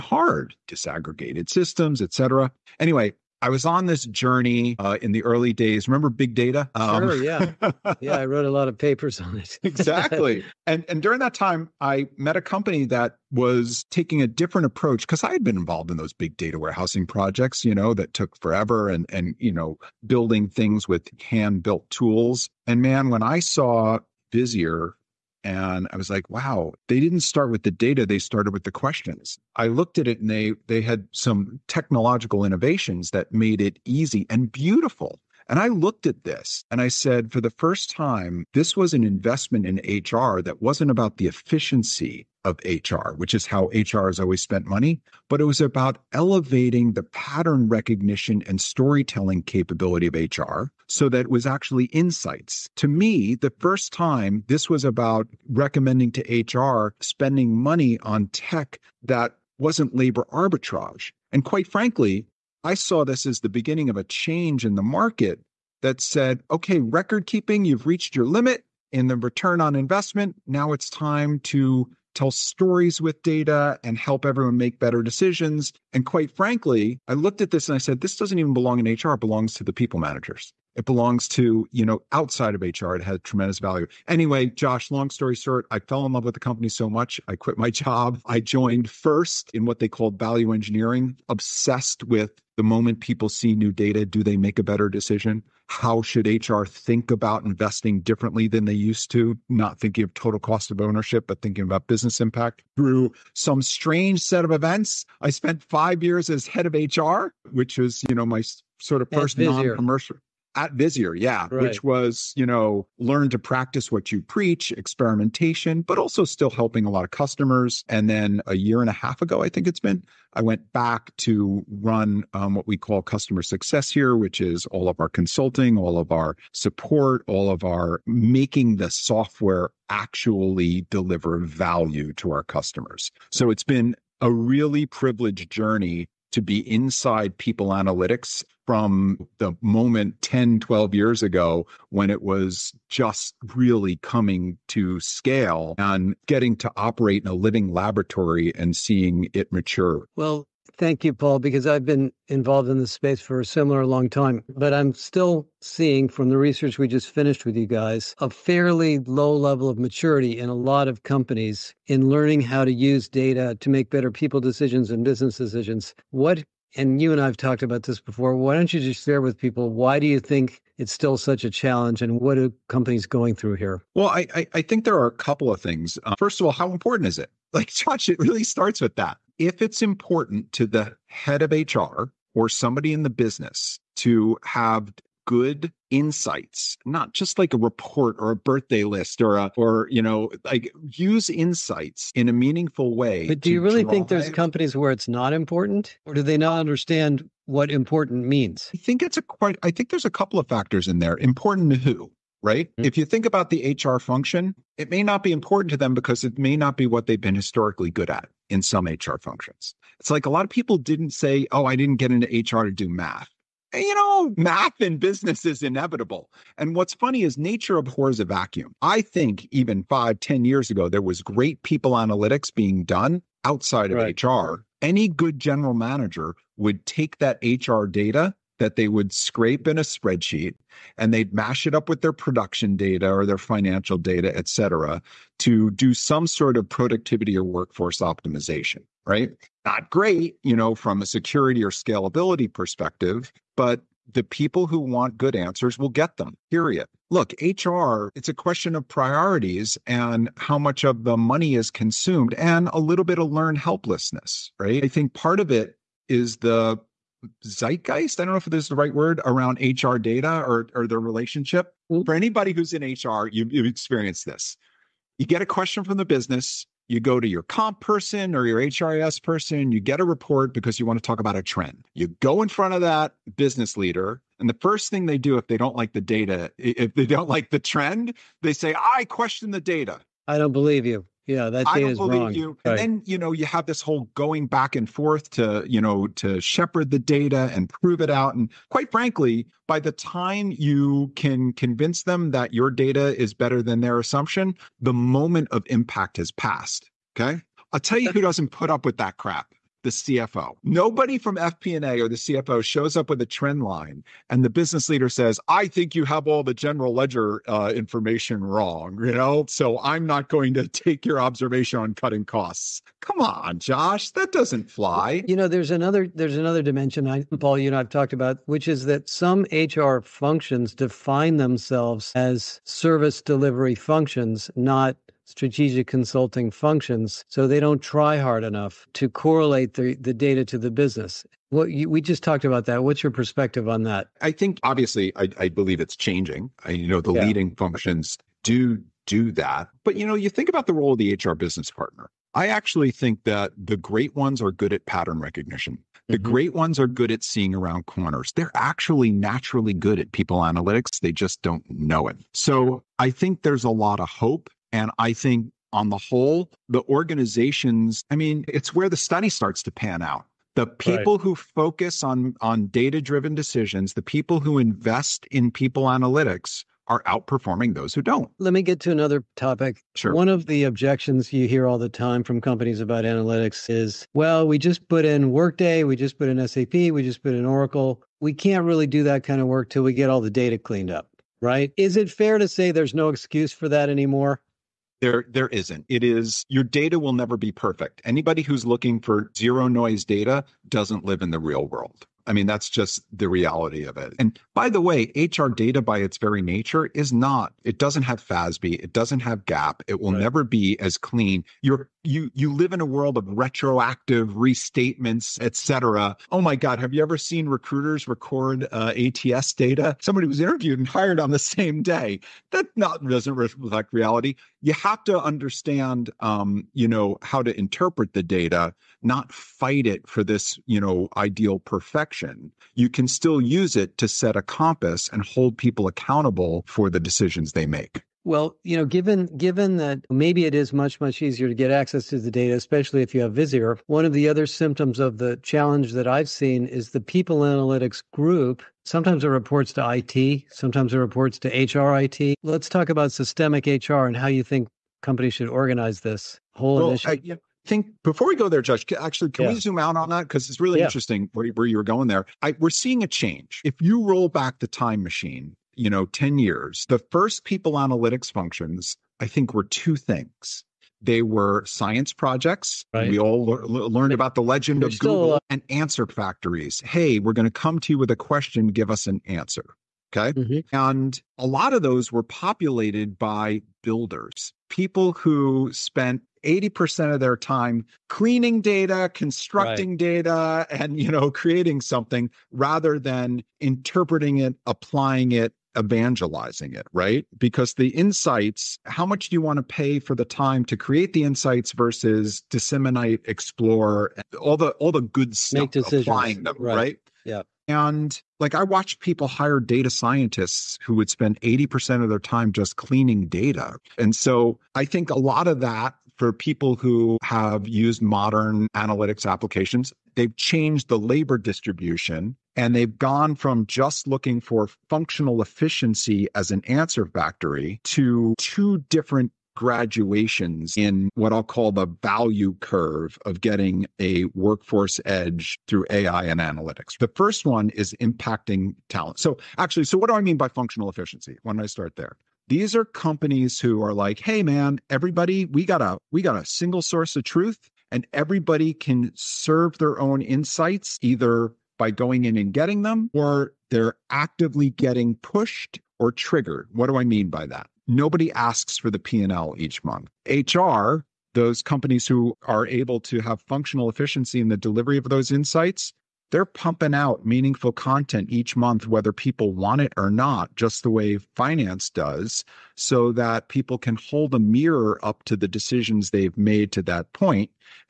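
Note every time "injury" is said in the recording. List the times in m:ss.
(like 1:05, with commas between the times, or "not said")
not said.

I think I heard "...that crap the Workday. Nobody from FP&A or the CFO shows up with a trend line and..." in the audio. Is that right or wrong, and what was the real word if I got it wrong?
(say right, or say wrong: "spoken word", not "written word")
wrong: "CFO", not "Workday".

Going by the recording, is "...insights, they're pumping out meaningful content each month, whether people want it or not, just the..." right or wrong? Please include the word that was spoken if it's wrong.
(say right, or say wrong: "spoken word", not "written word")
right.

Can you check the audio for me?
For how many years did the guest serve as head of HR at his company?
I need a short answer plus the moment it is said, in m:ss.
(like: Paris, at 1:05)
5, at 1:45.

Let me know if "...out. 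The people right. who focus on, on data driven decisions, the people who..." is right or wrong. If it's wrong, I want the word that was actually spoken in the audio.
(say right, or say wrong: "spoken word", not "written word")
right.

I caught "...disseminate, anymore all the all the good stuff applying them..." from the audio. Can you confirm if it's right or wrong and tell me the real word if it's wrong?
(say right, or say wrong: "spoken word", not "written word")
wrong: "explore", not "anymore".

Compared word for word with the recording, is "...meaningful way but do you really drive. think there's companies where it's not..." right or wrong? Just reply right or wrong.
right.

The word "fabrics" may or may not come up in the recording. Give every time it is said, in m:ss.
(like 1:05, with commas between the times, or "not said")
not said.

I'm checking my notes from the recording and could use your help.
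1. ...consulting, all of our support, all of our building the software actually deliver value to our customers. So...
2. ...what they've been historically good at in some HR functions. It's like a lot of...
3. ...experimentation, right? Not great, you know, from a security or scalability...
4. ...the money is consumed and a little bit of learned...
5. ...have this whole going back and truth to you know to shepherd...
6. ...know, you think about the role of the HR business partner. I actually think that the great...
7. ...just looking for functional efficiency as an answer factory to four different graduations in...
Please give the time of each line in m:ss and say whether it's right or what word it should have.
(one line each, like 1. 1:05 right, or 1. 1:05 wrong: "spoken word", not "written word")
1. 2:05 wrong: "making", not "building"
2. 3:26 right
3. 3:57 wrong: "optimization", not "experimentation"
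4. 4:11 right
5. 4:43 wrong: "forth", not "truth"
6. 5:40 right
7. 8:33 wrong: "two", not "four".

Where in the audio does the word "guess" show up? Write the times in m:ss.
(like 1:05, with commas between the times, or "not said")
not said.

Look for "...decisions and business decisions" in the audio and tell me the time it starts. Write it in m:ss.
2:44.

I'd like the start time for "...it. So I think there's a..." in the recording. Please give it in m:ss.
5:52.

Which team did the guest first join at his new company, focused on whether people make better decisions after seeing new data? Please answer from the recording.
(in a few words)
value engineering.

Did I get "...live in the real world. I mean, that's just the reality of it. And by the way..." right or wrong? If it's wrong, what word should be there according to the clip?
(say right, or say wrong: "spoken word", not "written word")
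right.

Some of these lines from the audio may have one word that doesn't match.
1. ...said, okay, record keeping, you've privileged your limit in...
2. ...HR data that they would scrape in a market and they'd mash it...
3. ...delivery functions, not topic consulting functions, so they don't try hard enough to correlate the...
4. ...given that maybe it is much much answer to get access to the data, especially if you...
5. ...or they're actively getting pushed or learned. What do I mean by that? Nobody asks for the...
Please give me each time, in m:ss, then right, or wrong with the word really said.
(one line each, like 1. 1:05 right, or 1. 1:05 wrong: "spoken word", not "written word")
1. 1:05 wrong: "reached", not "privileged"
2. 3:47 wrong: "spreadsheet", not "market"
3. 5:23 wrong: "strategic", not "topic"
4. 7:09 wrong: "easier", not "answer"
5. 9:03 wrong: "triggered", not "learned".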